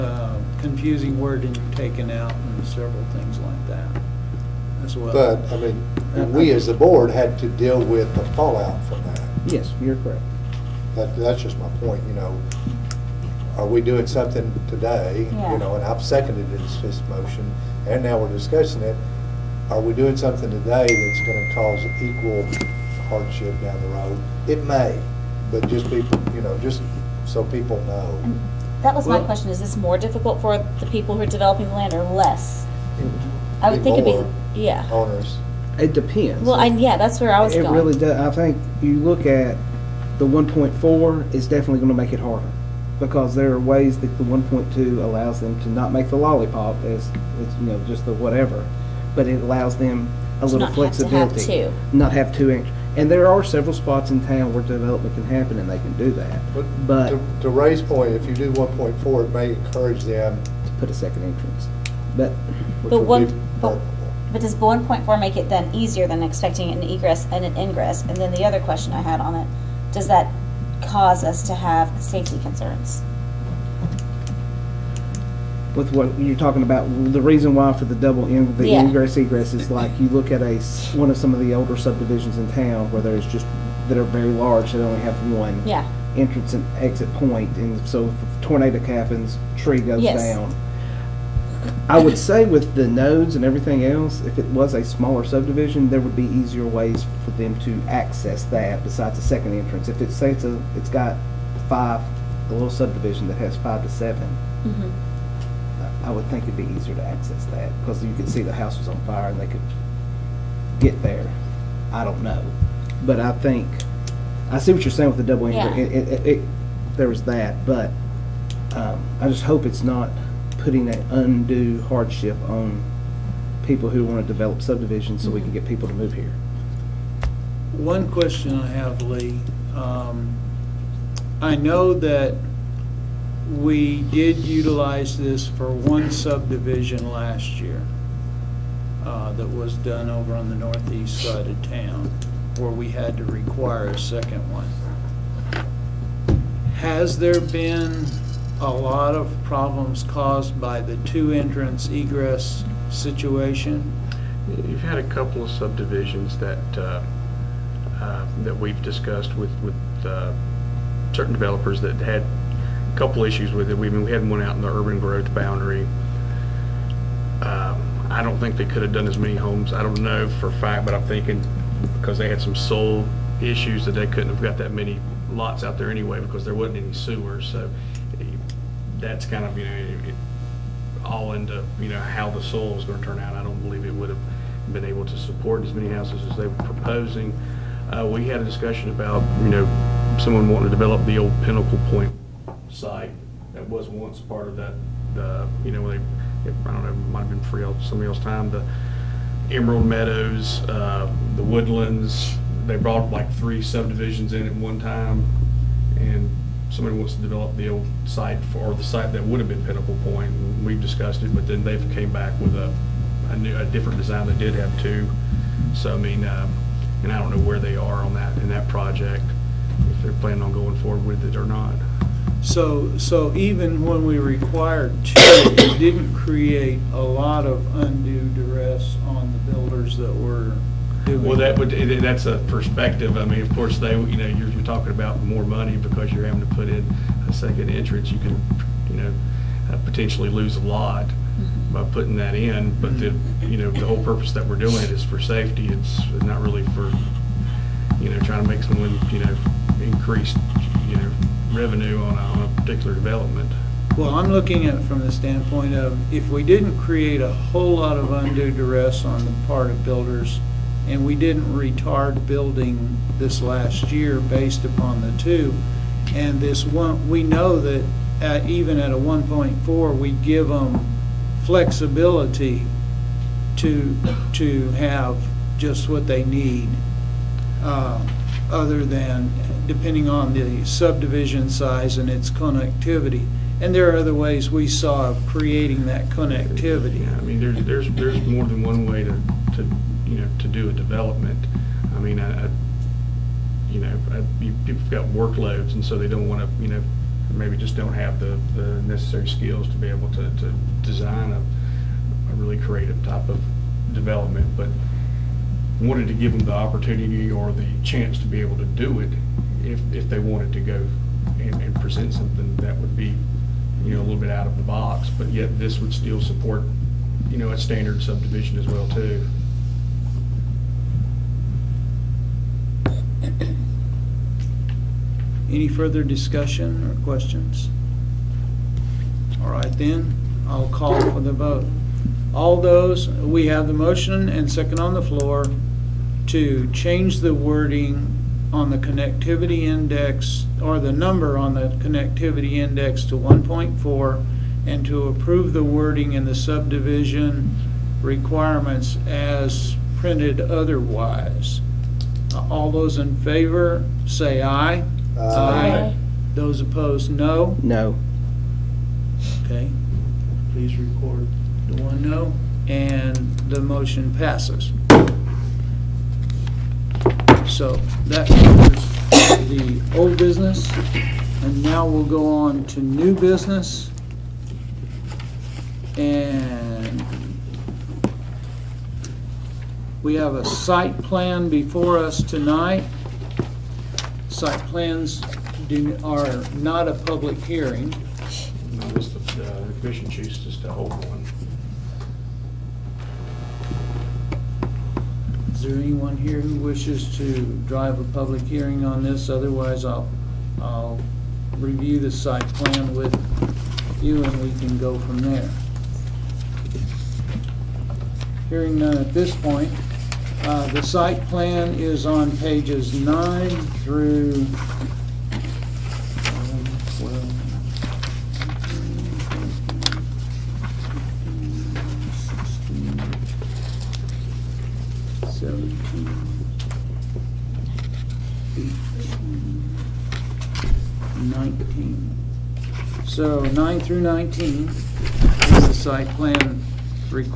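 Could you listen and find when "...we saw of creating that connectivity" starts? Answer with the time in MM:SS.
04:44.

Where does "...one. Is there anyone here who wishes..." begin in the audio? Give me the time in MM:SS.
06:31.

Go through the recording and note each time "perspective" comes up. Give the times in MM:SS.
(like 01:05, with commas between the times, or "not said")
03:52.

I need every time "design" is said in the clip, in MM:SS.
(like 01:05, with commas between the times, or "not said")
03:33, 05:00.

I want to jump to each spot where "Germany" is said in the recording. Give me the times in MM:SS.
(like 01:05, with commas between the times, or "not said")
not said.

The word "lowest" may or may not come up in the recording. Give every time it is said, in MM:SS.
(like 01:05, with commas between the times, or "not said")
not said.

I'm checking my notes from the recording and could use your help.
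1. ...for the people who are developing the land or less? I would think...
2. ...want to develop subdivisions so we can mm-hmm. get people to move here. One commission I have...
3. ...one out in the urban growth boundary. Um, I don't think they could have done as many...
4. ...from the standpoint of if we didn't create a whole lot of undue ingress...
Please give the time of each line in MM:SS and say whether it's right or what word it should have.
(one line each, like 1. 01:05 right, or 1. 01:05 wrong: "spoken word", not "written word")
1. 00:30 right
2. 02:04 wrong: "question", not "commission"
3. 02:44 right
4. 04:14 wrong: "duress", not "ingress".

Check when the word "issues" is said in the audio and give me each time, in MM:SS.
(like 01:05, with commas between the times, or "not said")
02:43, 02:53.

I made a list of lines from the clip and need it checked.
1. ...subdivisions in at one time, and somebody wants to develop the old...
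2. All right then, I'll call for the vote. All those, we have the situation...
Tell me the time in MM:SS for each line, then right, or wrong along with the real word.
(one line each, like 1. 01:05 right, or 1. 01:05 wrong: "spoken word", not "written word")
1. 03:23 right
2. 05:29 wrong: "motion", not "situation".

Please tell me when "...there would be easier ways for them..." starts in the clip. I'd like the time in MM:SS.
01:35.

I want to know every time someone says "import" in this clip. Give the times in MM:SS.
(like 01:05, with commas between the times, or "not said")
not said.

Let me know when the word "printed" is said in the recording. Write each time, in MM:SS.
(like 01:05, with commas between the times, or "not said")
05:49.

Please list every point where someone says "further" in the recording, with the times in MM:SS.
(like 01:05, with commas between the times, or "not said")
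05:25.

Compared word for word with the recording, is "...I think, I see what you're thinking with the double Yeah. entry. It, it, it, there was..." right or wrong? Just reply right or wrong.
wrong.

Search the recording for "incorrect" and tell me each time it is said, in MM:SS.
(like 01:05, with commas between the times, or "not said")
not said.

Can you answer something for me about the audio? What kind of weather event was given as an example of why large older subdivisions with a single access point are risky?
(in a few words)
Tornado.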